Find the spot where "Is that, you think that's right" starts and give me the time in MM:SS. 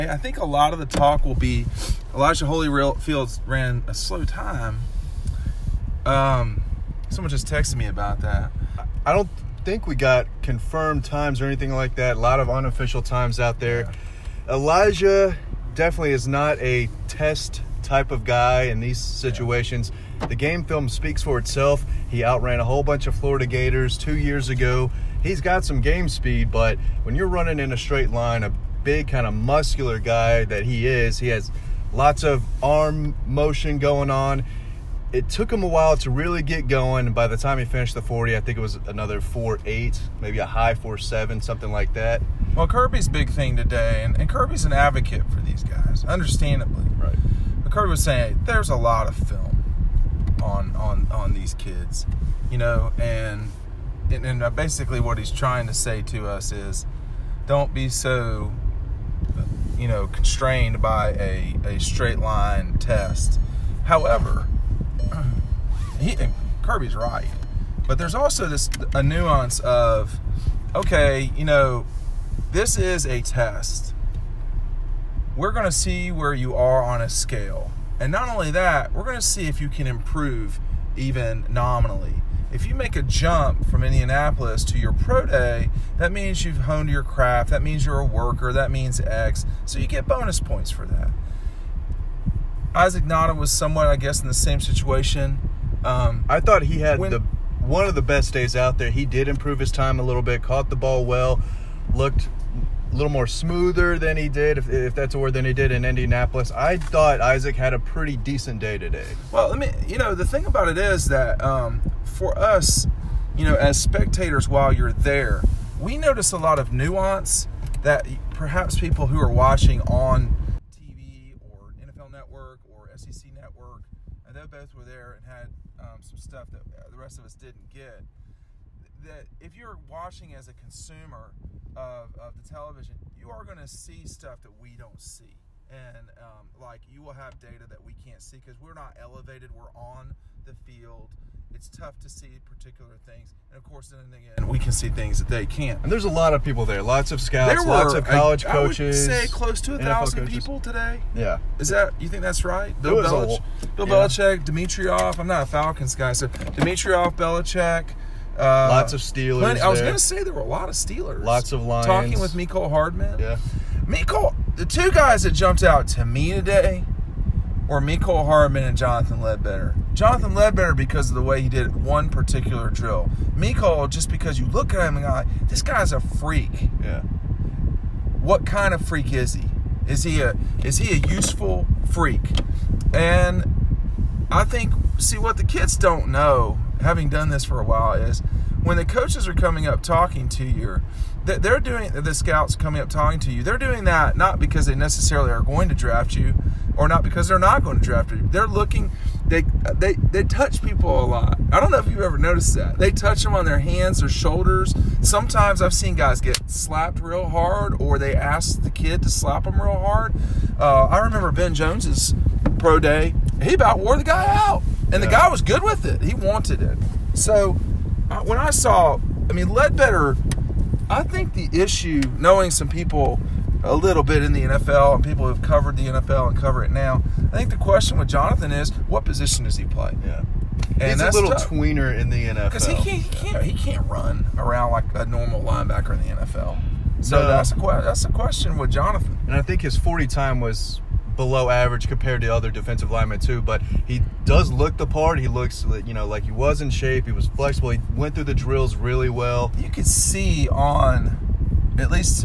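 02:31.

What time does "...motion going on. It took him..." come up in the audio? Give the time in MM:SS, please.
00:33.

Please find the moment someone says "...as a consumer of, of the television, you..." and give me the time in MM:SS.
02:10.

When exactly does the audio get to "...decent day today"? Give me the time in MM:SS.
01:48.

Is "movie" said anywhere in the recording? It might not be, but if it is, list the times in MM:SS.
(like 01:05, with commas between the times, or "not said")
not said.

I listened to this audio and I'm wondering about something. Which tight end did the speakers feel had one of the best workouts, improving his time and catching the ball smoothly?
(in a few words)
Isaac Nauta.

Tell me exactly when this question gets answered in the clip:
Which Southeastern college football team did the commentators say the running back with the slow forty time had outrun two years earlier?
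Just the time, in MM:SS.
00:23.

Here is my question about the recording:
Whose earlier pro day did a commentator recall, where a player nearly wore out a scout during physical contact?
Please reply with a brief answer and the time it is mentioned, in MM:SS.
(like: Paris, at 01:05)
Ben Jones, at 03:31.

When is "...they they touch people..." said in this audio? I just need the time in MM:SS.
03:19.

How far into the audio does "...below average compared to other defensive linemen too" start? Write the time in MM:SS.
04:01.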